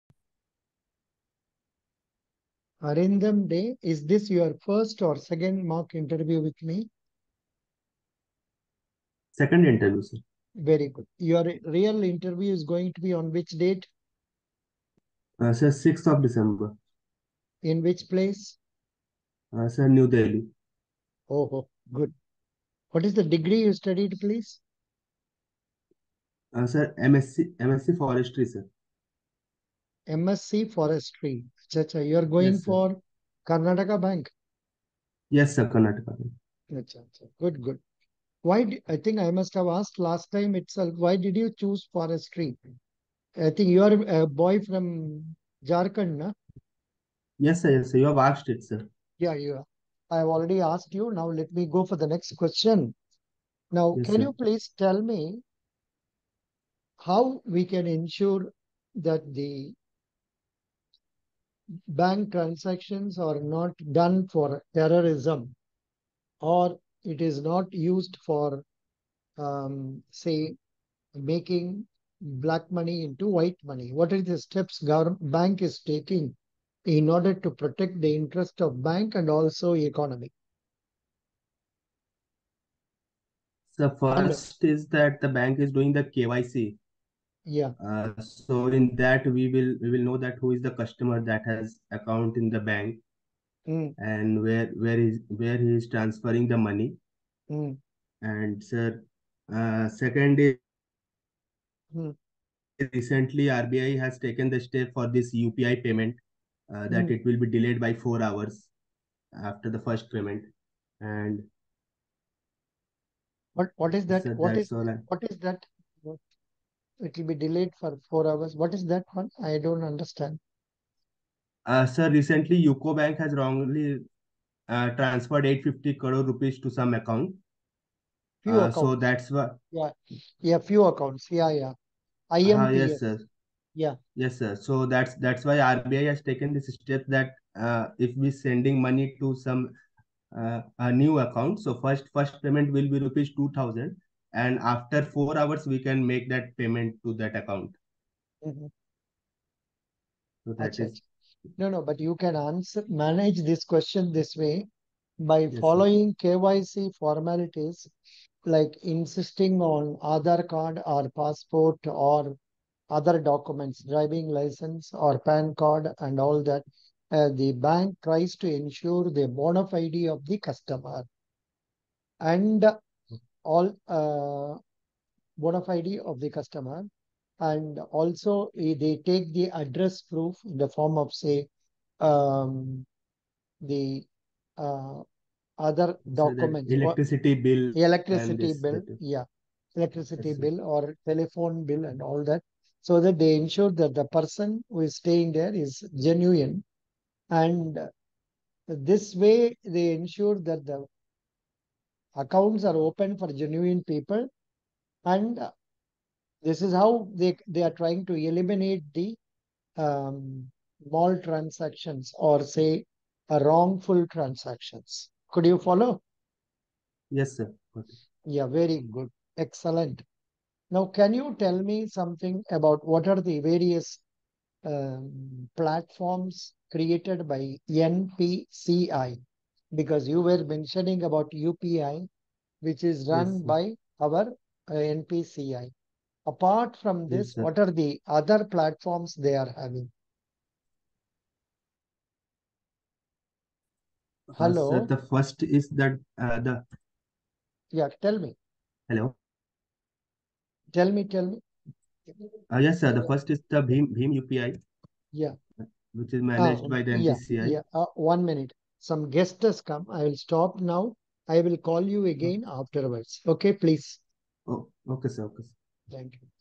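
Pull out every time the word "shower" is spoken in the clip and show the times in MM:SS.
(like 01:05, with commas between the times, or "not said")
not said.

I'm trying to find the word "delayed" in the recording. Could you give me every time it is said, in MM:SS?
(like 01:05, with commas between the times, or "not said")
01:47, 01:57.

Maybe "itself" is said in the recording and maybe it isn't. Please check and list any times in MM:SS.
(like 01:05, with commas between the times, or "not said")
00:40.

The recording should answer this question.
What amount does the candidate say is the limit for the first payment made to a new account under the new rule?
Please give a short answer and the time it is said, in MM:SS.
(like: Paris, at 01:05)
2000 rupees, at 02:22.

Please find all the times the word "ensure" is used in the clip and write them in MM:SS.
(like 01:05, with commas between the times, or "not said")
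00:57, 02:48, 03:13, 03:19.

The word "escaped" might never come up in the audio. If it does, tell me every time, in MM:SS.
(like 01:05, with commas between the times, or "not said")
not said.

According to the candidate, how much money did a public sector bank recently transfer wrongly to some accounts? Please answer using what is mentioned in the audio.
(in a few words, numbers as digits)
850 crore rupees.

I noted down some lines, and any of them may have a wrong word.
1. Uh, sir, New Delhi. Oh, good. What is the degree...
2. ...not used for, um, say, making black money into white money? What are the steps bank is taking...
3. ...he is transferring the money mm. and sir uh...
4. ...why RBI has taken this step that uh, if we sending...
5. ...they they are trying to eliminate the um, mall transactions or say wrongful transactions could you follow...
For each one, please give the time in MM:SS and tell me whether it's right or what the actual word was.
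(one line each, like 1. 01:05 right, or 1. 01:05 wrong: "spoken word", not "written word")
1. 00:19 right
2. 01:07 right
3. 01:35 right
4. 02:15 right
5. 03:27 right.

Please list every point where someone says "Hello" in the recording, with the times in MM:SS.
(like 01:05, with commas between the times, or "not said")
01:24, 04:04, 04:08.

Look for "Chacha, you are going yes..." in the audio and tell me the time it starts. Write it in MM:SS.
00:31.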